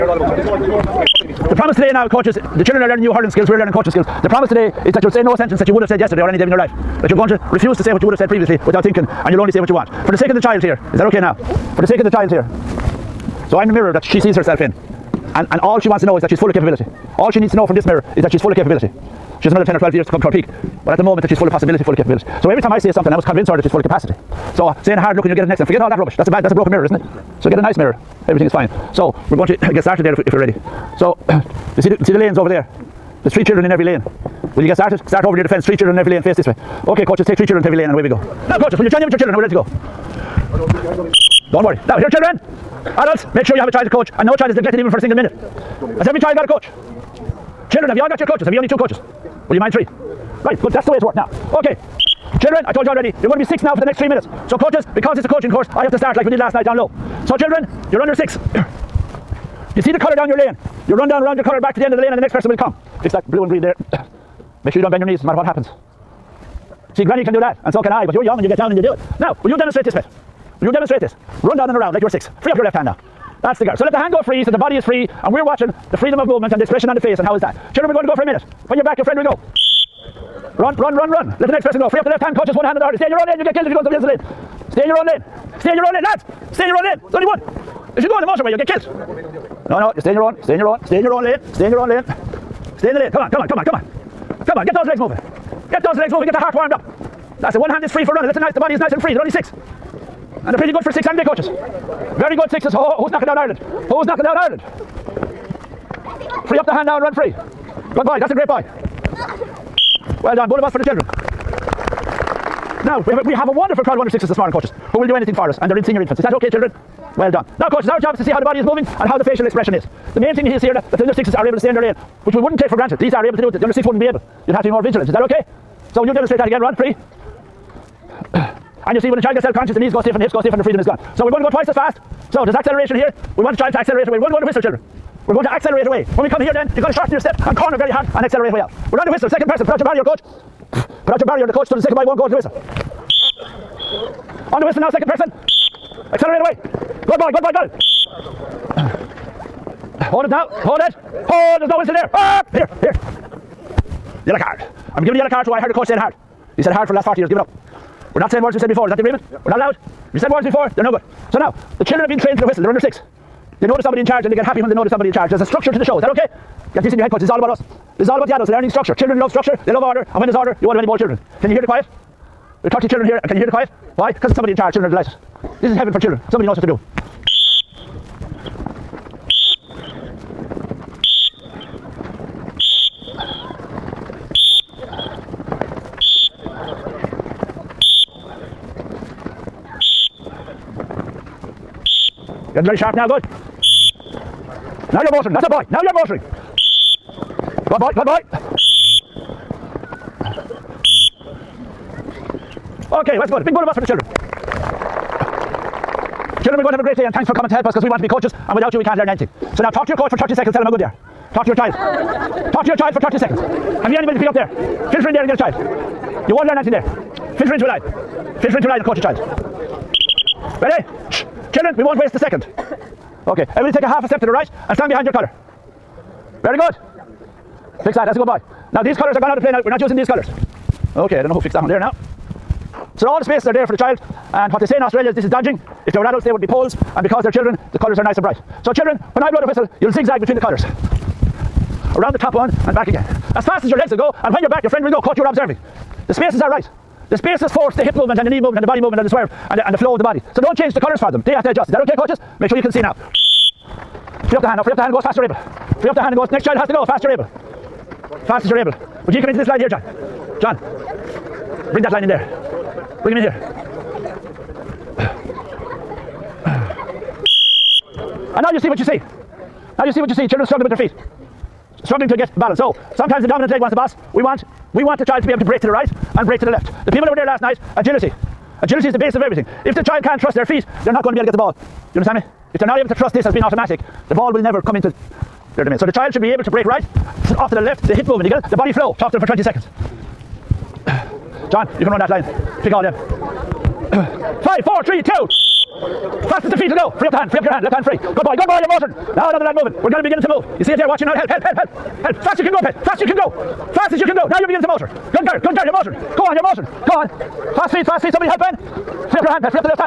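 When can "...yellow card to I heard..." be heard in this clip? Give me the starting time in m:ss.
2:35.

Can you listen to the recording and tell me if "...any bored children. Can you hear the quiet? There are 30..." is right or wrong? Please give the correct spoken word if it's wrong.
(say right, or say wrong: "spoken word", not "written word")
right.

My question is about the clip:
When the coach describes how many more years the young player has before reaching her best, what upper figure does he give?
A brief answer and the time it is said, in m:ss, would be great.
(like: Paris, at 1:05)
12, at 0:19.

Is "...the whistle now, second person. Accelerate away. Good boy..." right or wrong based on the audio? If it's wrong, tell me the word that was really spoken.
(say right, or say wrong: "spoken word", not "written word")
right.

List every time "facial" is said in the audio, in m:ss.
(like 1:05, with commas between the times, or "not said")
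1:59.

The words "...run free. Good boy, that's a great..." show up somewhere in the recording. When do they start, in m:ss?
1:47.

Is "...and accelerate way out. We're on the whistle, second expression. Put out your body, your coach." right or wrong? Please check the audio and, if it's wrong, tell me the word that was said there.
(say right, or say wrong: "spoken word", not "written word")
wrong: "person", not "expression".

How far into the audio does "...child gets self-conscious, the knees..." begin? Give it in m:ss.
2:09.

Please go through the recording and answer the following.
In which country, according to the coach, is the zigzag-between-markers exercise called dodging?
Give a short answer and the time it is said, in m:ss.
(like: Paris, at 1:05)
Australia, at 3:54.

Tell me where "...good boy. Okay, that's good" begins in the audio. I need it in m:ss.
3:17.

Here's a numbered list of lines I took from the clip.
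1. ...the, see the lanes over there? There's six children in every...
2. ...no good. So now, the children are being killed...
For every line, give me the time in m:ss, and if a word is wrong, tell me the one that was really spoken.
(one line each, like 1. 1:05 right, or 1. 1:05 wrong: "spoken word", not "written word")
1. 0:31 wrong: "three", not "six"
2. 2:40 wrong: "trained", not "killed".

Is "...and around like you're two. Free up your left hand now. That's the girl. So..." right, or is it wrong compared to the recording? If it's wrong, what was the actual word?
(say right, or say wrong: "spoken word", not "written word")
wrong: "six", not "two".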